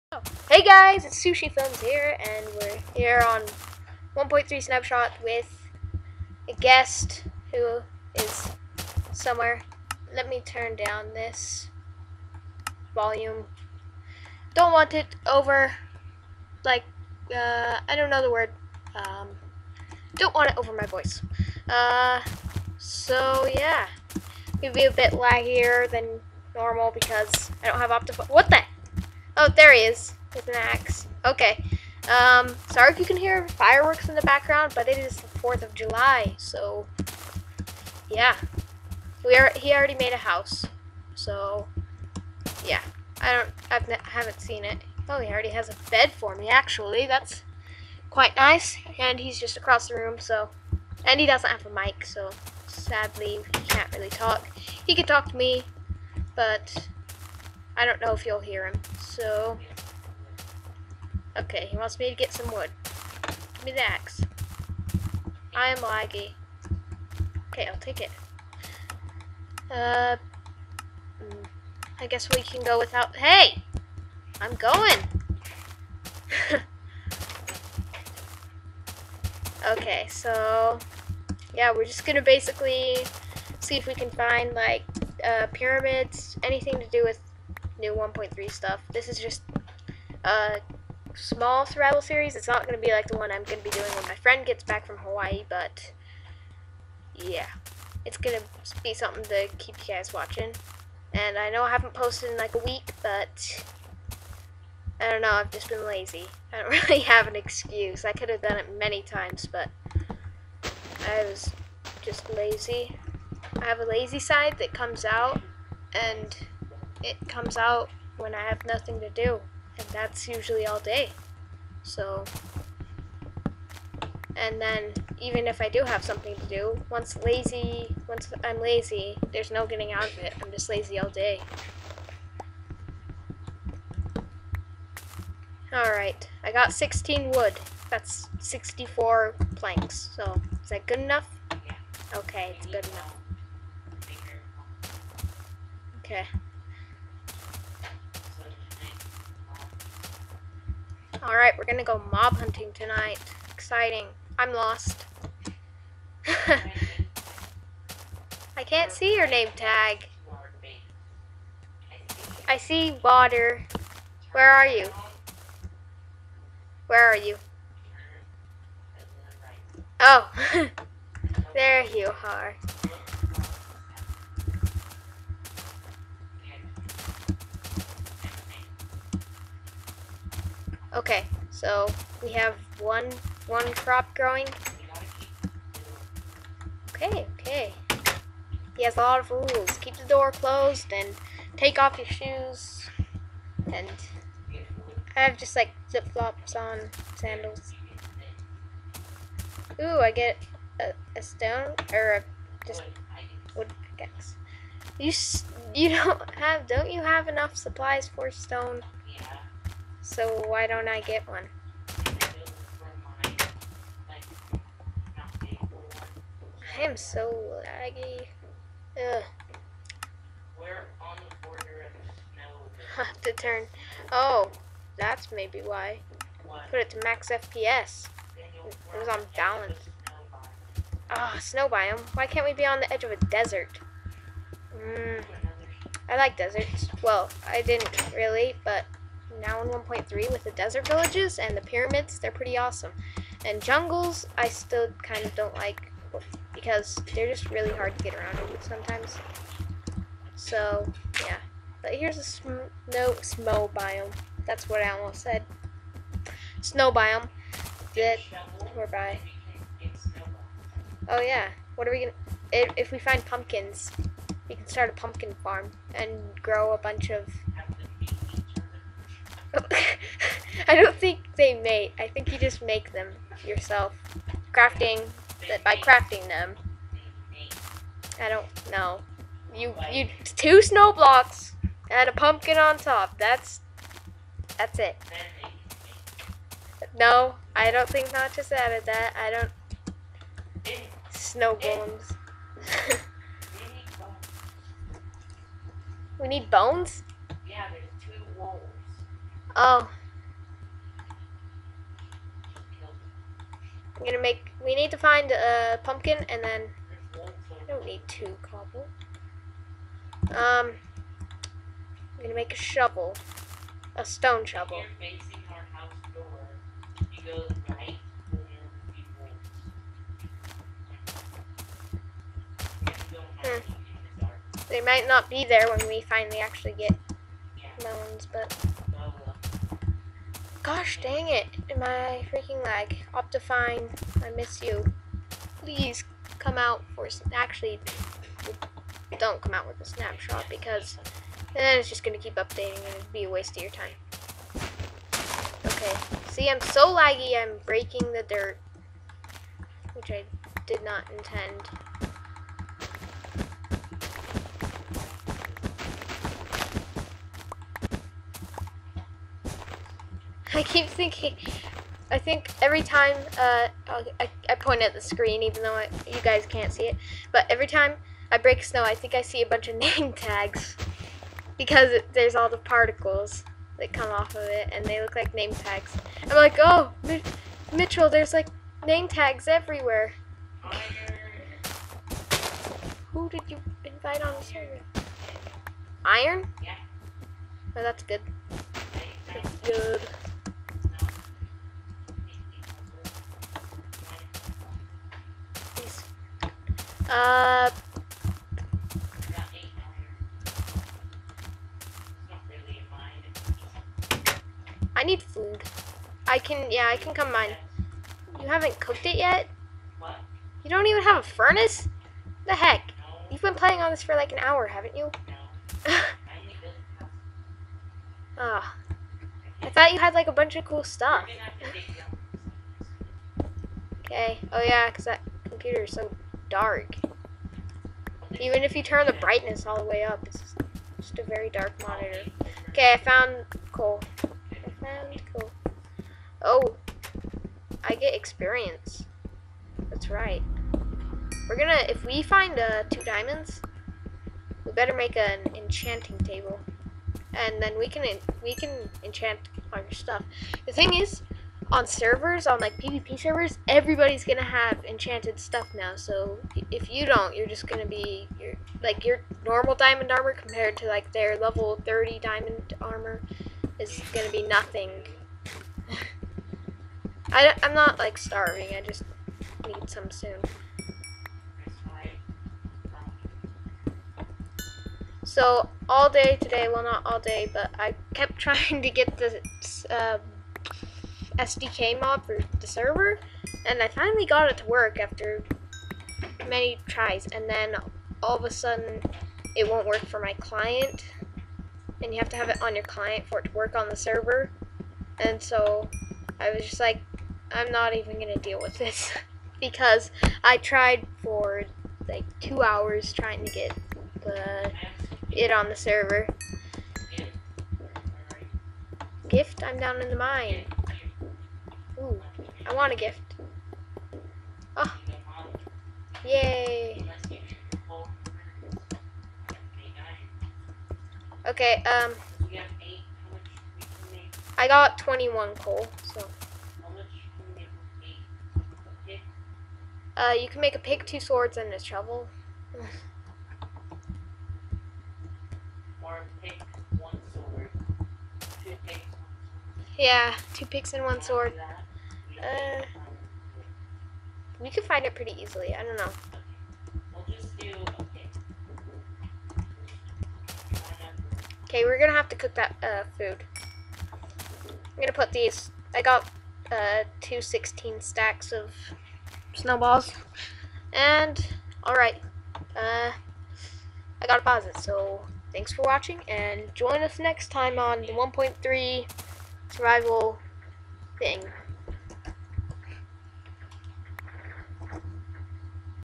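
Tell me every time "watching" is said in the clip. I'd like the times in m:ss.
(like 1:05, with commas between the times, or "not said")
1:40, 9:25.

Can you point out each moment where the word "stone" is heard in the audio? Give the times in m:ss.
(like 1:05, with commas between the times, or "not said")
3:21, 3:28, 5:14.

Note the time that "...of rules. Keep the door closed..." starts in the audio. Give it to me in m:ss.
3:09.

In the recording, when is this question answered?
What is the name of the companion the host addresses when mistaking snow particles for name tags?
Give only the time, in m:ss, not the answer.
6:17.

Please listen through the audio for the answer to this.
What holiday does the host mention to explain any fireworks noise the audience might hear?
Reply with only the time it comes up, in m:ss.
0:35.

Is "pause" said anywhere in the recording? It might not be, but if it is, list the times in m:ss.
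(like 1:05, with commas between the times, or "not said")
9:24.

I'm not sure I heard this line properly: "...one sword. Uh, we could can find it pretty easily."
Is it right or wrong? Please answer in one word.
right.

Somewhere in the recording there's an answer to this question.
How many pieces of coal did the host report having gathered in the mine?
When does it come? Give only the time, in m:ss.
8:44.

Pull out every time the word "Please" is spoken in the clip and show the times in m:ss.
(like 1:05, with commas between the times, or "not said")
5:35.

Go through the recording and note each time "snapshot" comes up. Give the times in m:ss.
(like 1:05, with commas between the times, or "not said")
0:04, 5:39.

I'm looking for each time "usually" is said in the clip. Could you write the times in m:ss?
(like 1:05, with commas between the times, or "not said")
2:00.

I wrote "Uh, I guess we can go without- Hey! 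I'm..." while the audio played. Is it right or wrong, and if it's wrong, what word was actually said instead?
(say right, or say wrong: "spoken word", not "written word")
right.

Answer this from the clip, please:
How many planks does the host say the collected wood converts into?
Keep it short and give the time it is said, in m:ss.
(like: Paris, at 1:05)
64, at 2:18.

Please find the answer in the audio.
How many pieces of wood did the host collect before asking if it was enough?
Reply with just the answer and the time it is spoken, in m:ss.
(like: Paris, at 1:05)
16, at 2:16.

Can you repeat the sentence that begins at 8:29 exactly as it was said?
Gift, I'm down in the mine.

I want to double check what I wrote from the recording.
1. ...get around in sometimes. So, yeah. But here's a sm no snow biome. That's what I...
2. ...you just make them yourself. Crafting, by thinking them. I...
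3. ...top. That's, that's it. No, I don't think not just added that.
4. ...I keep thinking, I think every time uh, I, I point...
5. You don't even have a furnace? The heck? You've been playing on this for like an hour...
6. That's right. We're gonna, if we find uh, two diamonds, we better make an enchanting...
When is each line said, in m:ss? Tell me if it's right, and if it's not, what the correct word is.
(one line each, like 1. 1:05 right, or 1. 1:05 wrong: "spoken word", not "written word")
1. 4:08 right
2. 4:32 wrong: "crafting", not "thinking"
3. 4:42 right
4. 6:00 right
5. 6:50 right
6. 7:19 right.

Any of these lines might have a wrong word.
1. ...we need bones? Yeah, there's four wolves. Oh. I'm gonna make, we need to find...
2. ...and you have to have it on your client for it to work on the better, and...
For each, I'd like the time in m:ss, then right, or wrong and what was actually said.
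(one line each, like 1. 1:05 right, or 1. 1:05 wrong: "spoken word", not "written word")
1. 4:56 wrong: "two", not "four"
2. 8:12 wrong: "server", not "better".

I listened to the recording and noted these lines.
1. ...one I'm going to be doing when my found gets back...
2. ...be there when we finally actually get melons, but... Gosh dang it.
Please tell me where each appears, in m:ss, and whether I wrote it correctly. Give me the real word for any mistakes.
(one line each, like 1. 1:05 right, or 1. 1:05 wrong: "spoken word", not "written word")
1. 1:33 wrong: "friend", not "found"
2. 5:25 right.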